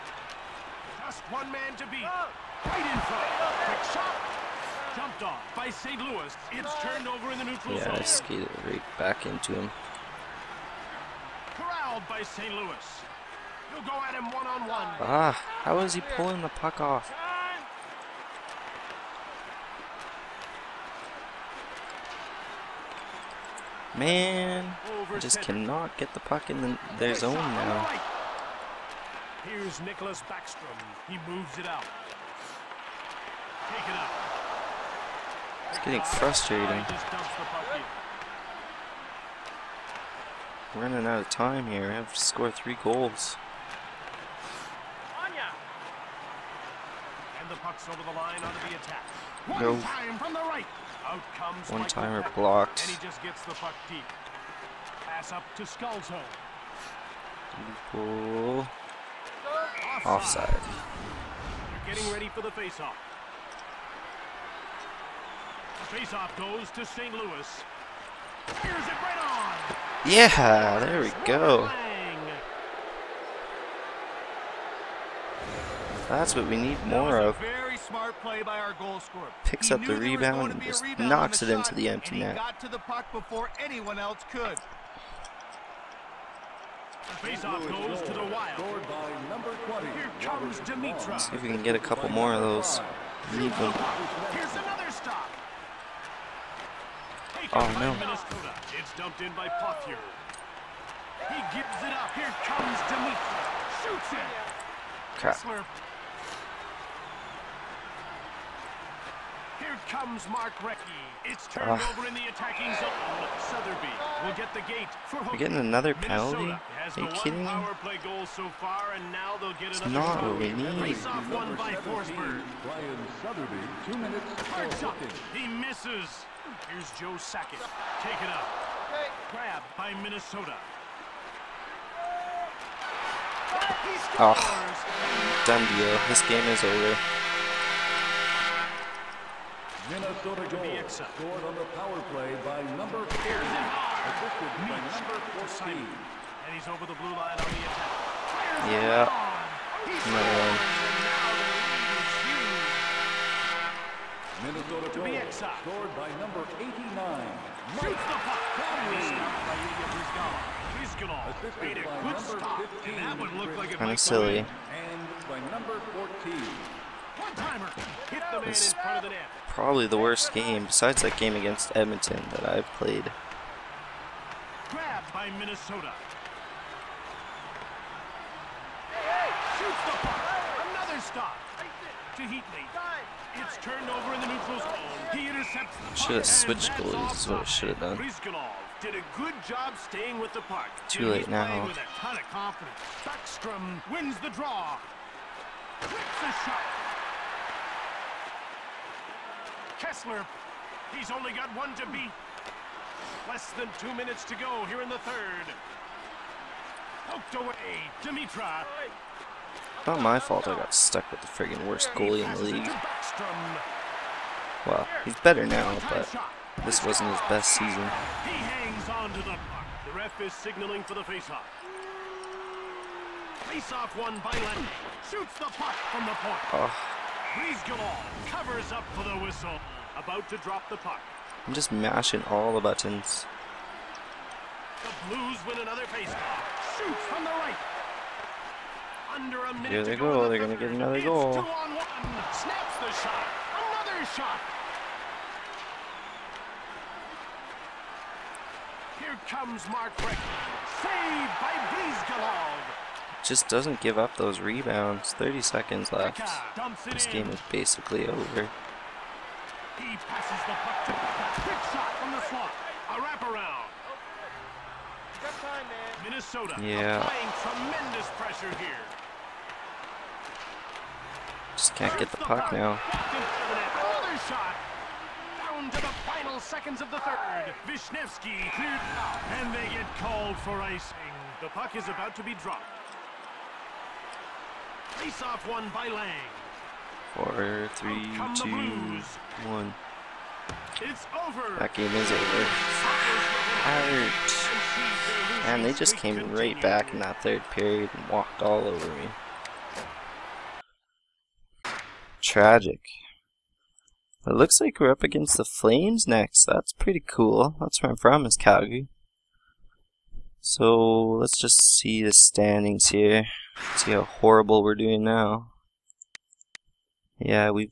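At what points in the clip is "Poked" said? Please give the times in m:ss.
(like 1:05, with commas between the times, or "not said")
3:27.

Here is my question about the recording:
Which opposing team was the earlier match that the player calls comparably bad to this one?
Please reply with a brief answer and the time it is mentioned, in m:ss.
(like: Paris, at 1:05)
Edmonton, at 2:51.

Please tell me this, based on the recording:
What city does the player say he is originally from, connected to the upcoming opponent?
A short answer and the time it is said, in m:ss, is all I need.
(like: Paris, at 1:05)
Calgary, at 5:08.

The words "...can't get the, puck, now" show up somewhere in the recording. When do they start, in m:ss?
4:31.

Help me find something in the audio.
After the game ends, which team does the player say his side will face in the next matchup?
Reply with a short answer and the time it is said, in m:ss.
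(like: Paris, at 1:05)
Flames, at 5:05.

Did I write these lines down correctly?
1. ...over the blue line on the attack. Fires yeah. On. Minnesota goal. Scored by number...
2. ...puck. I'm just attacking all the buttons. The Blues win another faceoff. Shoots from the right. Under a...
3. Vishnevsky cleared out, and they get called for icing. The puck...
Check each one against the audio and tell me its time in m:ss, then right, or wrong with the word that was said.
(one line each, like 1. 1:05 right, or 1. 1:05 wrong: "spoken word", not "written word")
1. 2:26 right
2. 3:50 wrong: "mashing", not "attacking"
3. 4:37 right.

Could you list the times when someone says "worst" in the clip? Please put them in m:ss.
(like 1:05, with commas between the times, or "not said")
2:49, 3:31.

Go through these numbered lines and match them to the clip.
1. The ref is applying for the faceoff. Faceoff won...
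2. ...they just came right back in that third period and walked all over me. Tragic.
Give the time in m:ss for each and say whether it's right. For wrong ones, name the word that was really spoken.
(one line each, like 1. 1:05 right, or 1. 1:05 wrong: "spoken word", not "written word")
1. 3:39 wrong: "signaling", not "applying"
2. 4:55 right.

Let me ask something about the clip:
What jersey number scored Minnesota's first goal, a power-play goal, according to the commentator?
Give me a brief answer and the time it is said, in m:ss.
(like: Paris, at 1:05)
40, at 2:22.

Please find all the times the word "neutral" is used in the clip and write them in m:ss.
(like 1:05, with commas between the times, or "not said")
0:07, 3:04.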